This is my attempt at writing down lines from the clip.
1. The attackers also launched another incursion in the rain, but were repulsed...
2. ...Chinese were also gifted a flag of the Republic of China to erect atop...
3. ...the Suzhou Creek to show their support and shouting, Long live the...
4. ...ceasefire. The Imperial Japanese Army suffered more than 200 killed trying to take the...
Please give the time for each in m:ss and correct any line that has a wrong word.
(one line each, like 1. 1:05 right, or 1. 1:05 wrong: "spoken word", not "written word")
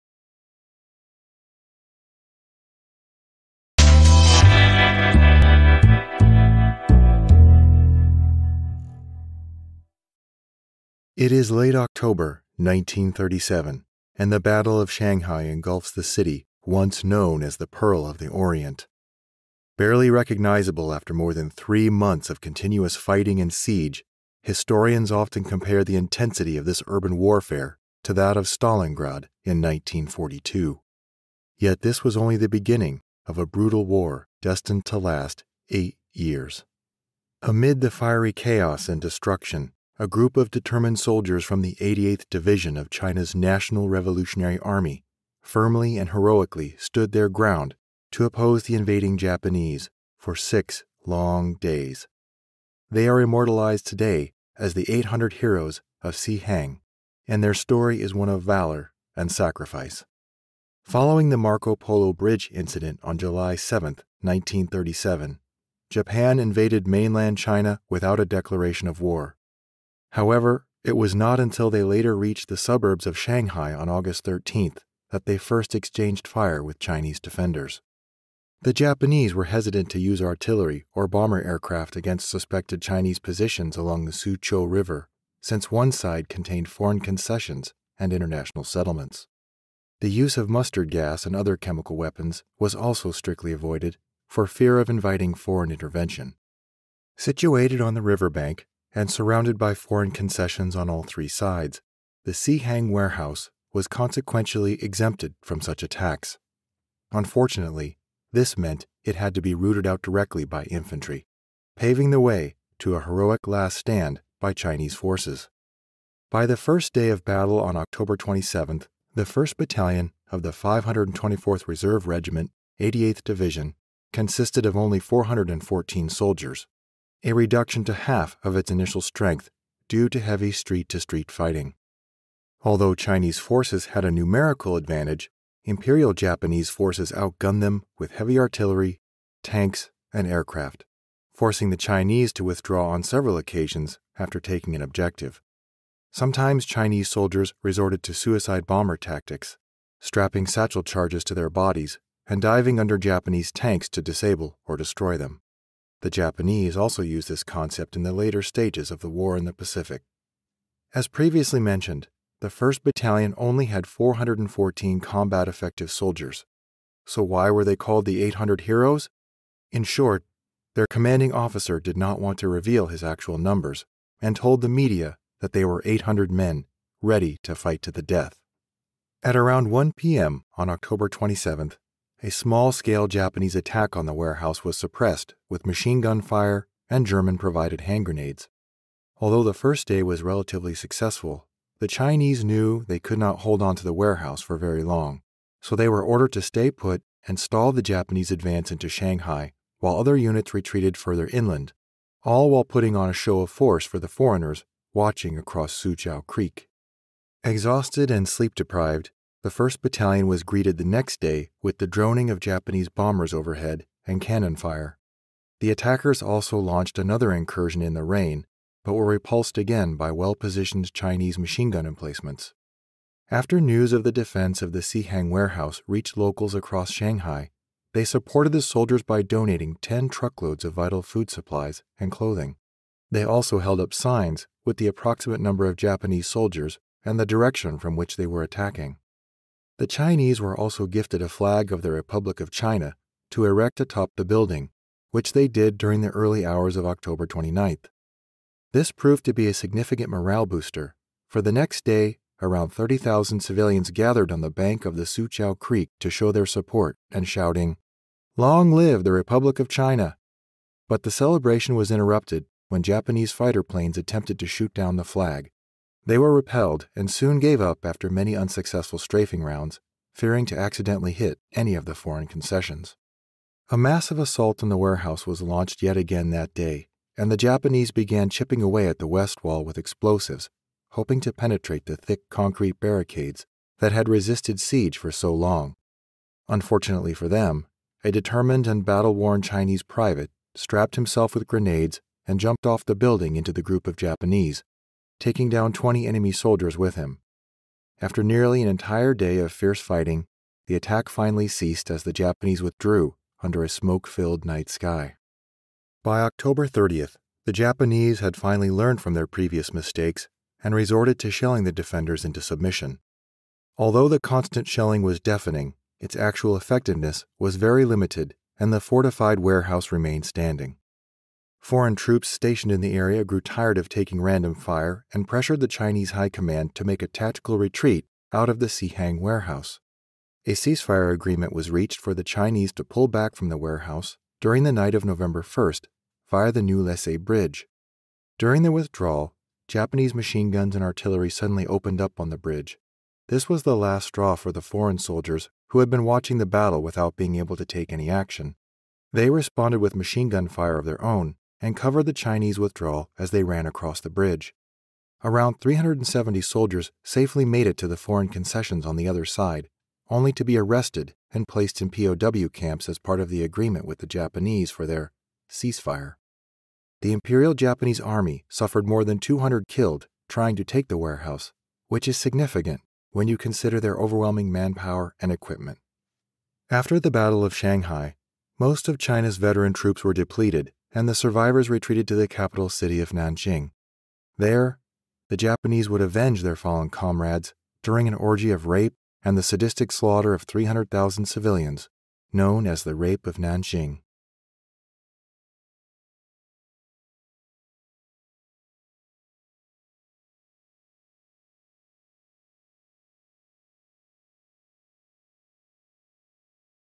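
1. 3:35 right
2. 3:59 right
3. 4:14 right
4. 6:05 right.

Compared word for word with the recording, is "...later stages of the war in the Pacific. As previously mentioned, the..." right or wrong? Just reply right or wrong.
right.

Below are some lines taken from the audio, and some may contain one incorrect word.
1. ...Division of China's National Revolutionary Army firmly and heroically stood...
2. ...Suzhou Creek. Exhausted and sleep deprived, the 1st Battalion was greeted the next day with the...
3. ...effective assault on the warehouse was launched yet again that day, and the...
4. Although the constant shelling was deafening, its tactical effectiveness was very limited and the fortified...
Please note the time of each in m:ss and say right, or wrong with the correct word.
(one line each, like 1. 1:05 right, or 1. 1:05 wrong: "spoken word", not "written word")
1. 0:42 right
2. 3:25 right
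3. 4:33 wrong: "massive", not "effective"
4. 5:13 wrong: "actual", not "tactical".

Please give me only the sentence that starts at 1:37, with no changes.
Situated on the riverbank, and surrounded by foreign concessions on all three sides, the Hang warehouse was consequentially exempted from such attacks.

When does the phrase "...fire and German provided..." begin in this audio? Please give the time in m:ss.
3:06.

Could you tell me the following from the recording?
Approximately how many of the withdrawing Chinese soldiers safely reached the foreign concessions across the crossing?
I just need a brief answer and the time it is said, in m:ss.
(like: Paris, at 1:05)
370, at 5:55.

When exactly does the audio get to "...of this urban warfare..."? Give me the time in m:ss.
0:26.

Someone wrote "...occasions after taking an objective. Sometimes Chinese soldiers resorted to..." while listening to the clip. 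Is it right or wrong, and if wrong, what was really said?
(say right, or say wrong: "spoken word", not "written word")
right.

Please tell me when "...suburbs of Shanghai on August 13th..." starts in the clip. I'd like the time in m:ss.
1:12.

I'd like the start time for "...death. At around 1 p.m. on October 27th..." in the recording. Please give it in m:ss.
2:58.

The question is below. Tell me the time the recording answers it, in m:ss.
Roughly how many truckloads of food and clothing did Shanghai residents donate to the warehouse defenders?
3:49.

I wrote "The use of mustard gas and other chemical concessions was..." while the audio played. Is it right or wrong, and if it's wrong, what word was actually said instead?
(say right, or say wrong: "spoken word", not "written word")
wrong: "weapons", not "concessions".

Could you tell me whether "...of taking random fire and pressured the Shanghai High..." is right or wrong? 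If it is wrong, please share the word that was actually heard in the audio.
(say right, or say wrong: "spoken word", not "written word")
wrong: "Chinese", not "Shanghai".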